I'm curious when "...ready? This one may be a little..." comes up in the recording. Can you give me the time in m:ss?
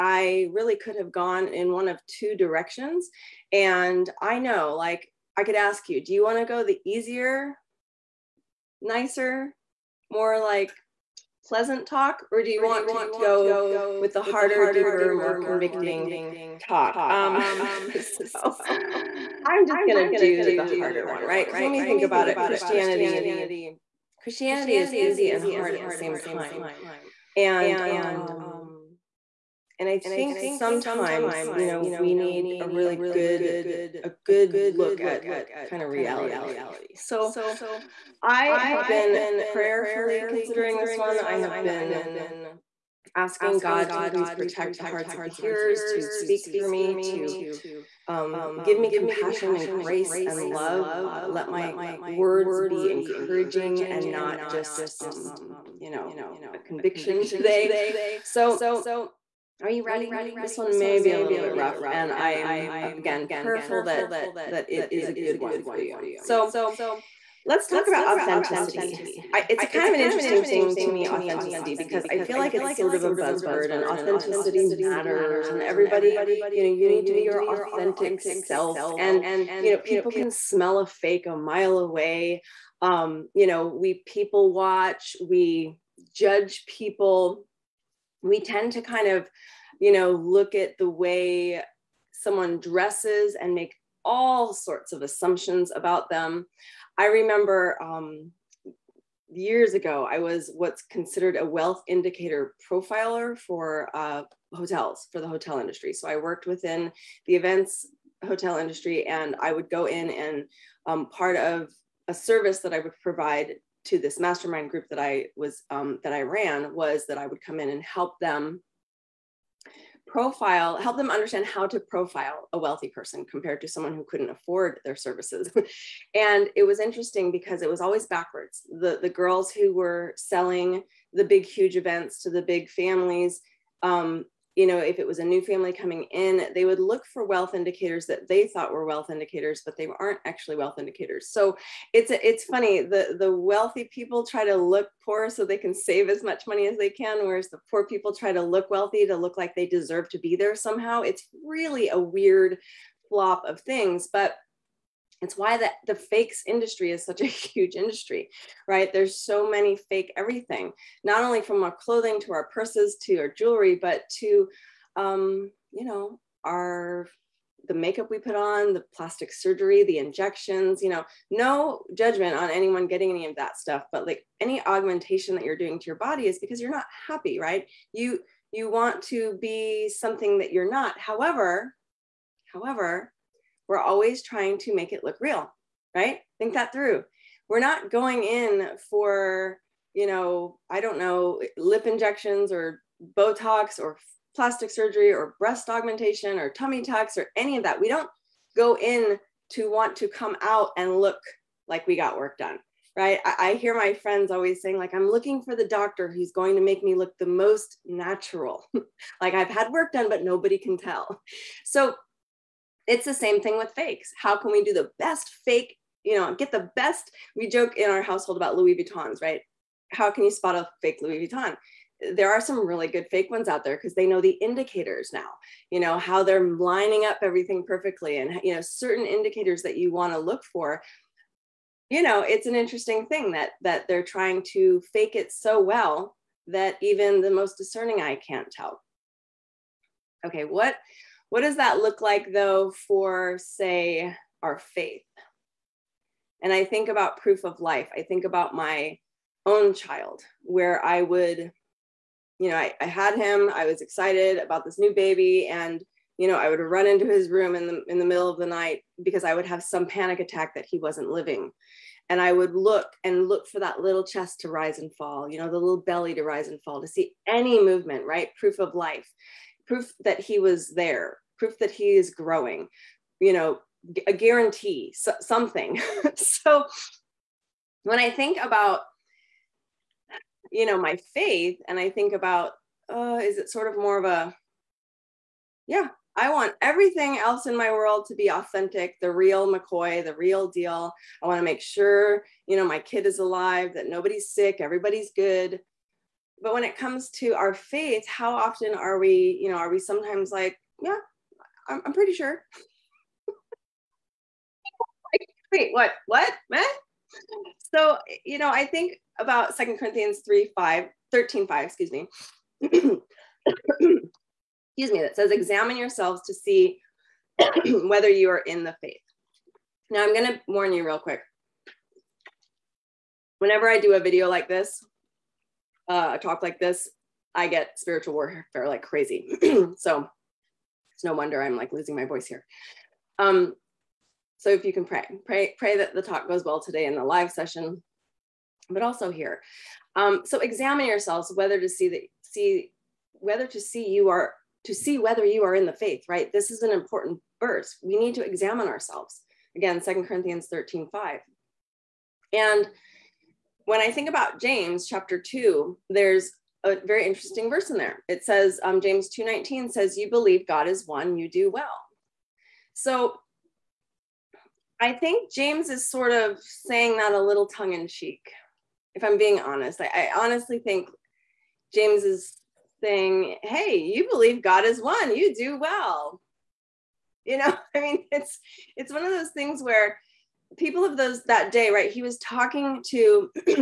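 0:59.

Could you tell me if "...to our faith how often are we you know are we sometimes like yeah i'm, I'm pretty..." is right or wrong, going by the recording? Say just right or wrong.
right.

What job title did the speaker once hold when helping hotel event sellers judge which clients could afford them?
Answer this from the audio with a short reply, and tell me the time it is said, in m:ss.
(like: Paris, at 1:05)
Wealth indicator profiler, at 1:41.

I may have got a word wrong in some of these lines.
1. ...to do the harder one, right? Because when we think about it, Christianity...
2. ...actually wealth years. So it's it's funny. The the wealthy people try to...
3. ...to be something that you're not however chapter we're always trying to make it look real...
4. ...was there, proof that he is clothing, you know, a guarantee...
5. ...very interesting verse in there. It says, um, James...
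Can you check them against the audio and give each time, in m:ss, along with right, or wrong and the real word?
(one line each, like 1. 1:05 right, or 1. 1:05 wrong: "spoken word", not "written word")
1. 0:20 right
2. 2:20 wrong: "indicators", not "years"
3. 2:59 wrong: "however", not "chapter"
4. 4:30 wrong: "growing", not "clothing"
5. 5:56 right.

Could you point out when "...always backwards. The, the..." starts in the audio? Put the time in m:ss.
2:07.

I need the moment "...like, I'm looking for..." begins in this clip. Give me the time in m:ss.
3:24.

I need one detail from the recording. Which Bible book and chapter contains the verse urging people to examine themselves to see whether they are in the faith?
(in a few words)
Second Corinthians 13.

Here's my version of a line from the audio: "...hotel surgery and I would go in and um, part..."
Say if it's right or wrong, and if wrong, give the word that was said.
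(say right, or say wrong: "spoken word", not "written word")
wrong: "industry", not "surgery".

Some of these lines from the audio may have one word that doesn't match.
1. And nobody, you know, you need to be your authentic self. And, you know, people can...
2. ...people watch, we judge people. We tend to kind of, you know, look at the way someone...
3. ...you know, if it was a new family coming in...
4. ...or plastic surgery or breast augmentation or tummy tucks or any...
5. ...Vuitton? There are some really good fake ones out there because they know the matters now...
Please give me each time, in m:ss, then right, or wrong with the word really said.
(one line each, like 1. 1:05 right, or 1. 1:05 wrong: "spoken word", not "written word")
1. 1:15 wrong: "everybody", not "nobody"
2. 1:24 right
3. 2:14 right
4. 3:13 right
5. 3:41 wrong: "indicators", not "matters".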